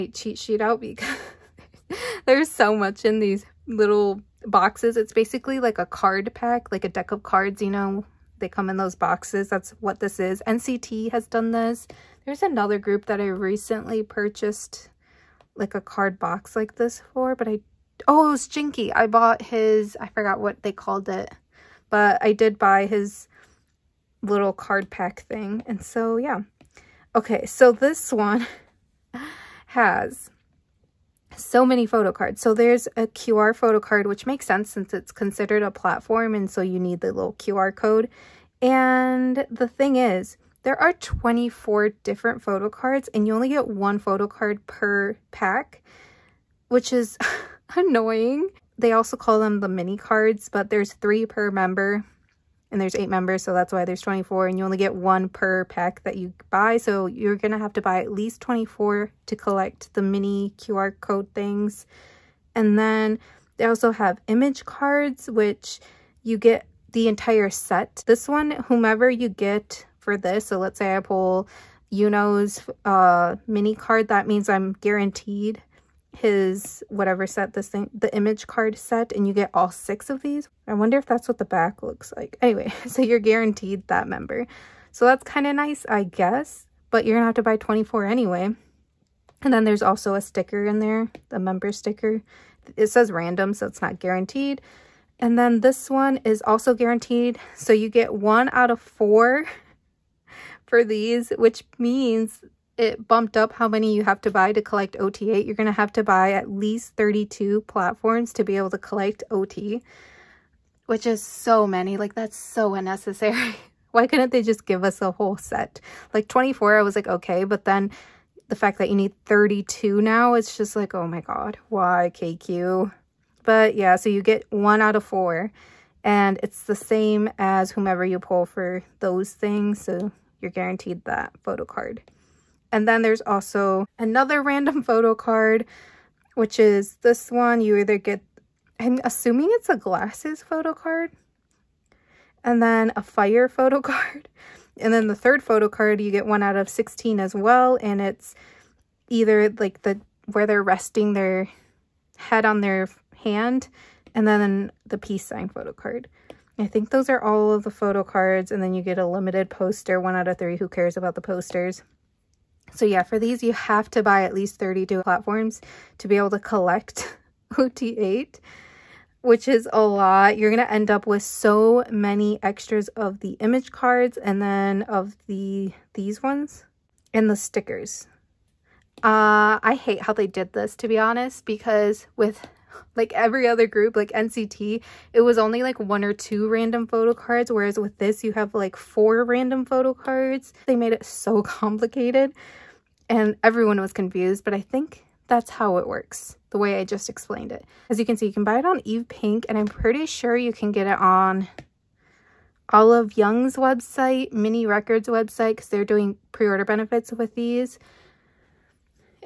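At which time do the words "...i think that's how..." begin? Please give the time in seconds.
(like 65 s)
194 s.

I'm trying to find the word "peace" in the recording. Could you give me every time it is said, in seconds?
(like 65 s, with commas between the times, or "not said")
154 s.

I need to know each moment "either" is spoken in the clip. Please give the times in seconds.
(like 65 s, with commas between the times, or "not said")
137 s, 149 s.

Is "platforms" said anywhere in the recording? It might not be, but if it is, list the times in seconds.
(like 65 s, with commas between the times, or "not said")
35 s, 107 s, 165 s.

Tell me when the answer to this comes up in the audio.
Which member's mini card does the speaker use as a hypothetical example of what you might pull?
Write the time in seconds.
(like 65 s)
71 s.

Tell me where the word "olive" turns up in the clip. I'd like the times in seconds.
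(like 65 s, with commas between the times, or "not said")
202 s.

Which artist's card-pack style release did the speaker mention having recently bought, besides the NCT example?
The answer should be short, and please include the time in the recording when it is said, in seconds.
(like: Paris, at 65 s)
Jinky, at 18 s.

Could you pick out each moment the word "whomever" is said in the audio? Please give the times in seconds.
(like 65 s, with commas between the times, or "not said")
68 s, 127 s.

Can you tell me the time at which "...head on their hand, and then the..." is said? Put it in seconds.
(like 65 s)
152 s.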